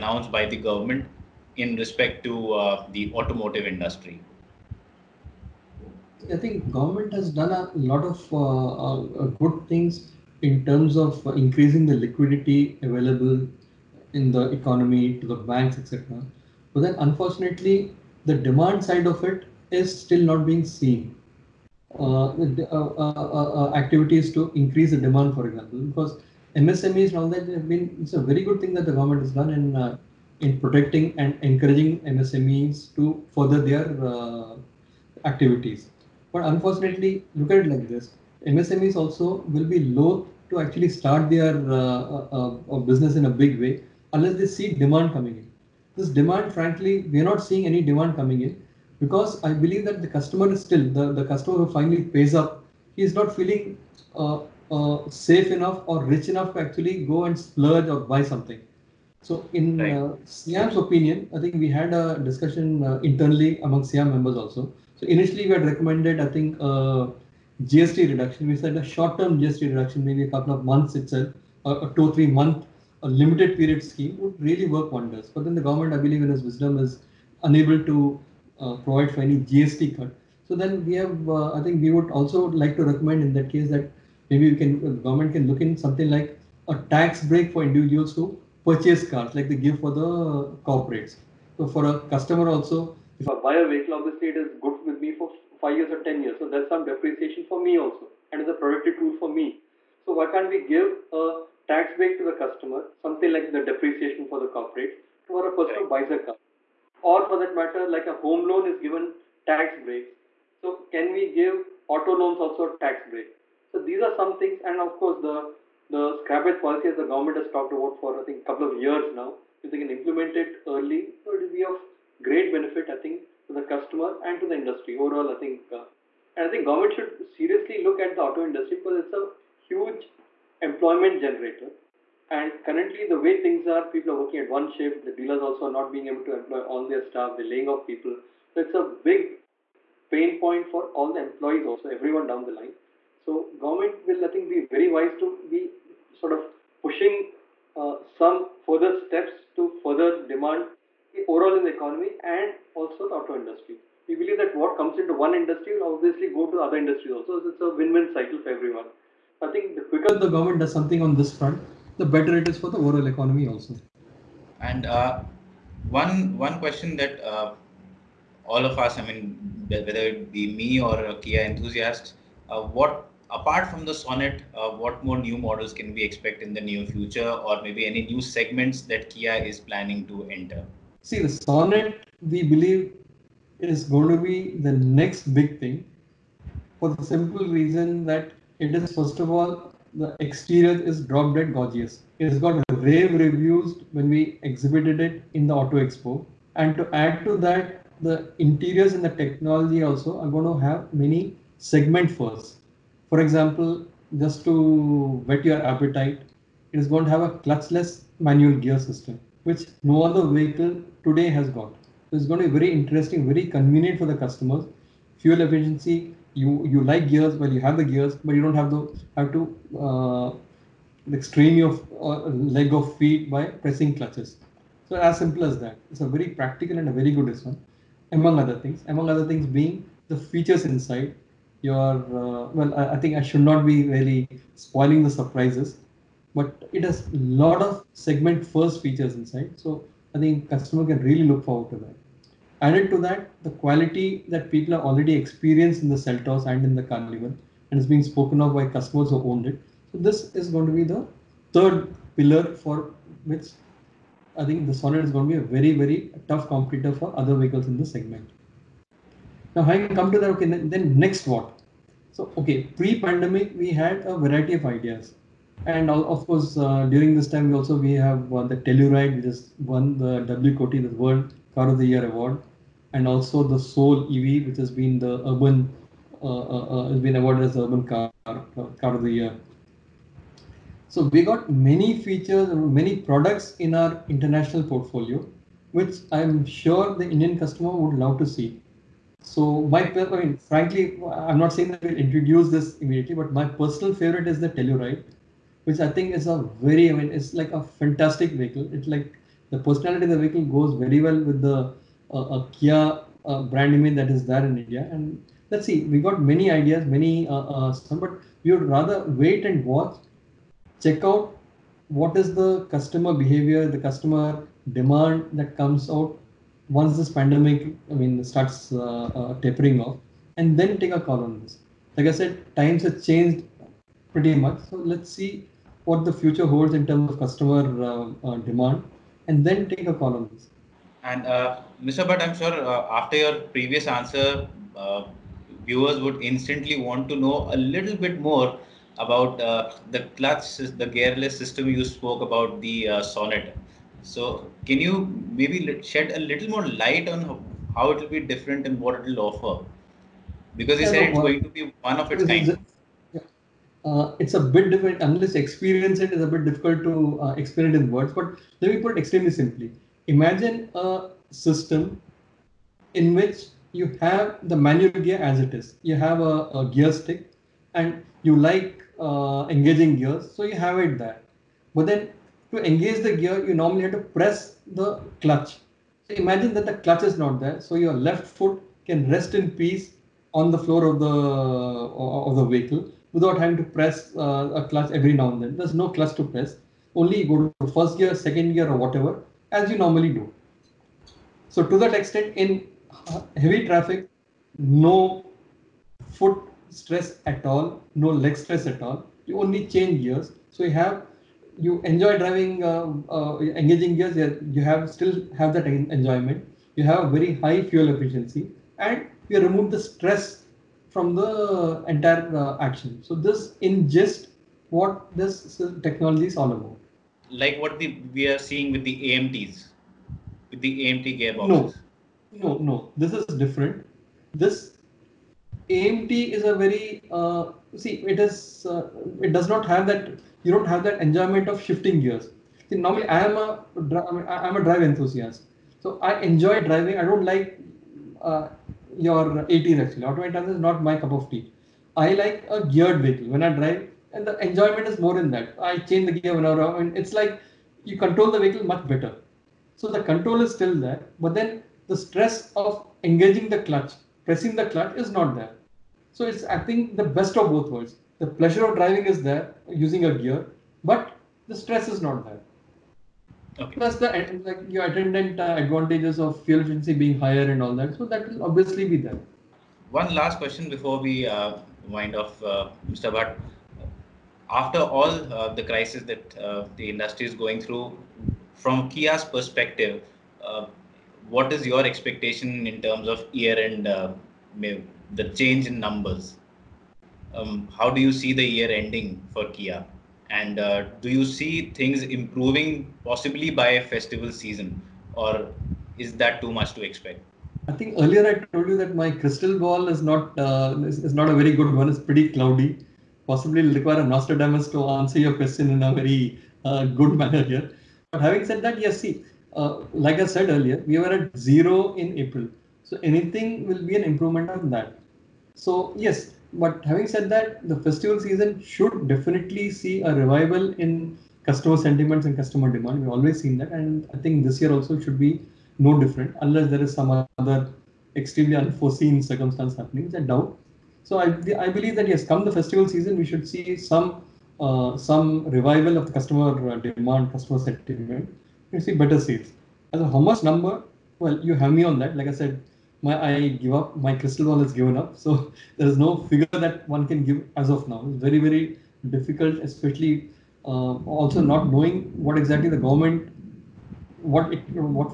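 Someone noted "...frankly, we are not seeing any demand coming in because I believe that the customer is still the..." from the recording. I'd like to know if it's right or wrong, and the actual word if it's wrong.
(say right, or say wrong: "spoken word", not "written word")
right.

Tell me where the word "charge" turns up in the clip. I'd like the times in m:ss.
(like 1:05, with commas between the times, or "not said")
not said.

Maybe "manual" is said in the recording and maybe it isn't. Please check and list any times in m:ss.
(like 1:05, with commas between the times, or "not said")
3:28, 6:04.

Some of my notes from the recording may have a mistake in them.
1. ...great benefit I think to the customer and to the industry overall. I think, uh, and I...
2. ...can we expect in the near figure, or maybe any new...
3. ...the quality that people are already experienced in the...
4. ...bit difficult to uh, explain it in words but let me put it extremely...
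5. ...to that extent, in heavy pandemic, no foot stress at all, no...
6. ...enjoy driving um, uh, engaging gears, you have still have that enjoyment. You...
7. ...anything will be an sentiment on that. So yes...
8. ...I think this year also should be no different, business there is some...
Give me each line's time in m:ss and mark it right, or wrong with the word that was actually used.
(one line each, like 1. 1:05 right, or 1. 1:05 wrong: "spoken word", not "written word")
1. 2:02 right
2. 2:55 wrong: "future", not "figure"
3. 4:03 right
4. 5:56 right
5. 6:31 wrong: "traffic", not "pandemic"
6. 6:41 right
7. 8:33 wrong: "improvement", not "sentiment"
8. 8:44 wrong: "unless", not "business".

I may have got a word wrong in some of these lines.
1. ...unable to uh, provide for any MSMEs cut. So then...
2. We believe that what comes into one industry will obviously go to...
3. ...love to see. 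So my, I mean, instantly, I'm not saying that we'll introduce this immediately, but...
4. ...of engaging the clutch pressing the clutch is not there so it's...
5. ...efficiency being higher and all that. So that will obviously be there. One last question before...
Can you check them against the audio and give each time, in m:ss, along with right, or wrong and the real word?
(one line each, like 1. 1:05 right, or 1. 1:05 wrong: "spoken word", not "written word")
1. 1:17 wrong: "GST", not "MSMEs"
2. 2:34 right
3. 4:47 wrong: "frankly", not "instantly"
4. 7:32 right
5. 7:46 right.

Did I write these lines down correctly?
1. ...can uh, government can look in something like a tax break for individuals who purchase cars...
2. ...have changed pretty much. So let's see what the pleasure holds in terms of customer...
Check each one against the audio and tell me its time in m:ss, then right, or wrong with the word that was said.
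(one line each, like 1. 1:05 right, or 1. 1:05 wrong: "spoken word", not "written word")
1. 1:24 right
2. 5:22 wrong: "future", not "pleasure".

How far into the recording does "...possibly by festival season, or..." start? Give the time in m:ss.
8:13.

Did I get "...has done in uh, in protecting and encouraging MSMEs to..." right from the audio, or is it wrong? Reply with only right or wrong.
right.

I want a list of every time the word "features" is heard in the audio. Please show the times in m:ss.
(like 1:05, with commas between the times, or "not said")
3:50, 3:58, 4:42.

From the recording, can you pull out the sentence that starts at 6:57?
Like what the, we are seeing with the AMTs, with the AMT gearboxes.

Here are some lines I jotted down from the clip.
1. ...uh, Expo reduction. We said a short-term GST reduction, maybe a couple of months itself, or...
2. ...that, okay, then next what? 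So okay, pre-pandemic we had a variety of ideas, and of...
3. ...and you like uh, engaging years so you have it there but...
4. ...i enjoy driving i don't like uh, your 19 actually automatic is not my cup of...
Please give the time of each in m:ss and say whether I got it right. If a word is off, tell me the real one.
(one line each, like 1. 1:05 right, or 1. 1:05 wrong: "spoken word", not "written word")
1. 1:06 wrong: "GST", not "Expo"
2. 4:20 right
3. 6:07 wrong: "gears", not "years"
4. 7:16 wrong: "18", not "19".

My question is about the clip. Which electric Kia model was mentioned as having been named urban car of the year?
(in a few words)
Soul EV.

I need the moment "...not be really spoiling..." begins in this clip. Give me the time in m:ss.
3:53.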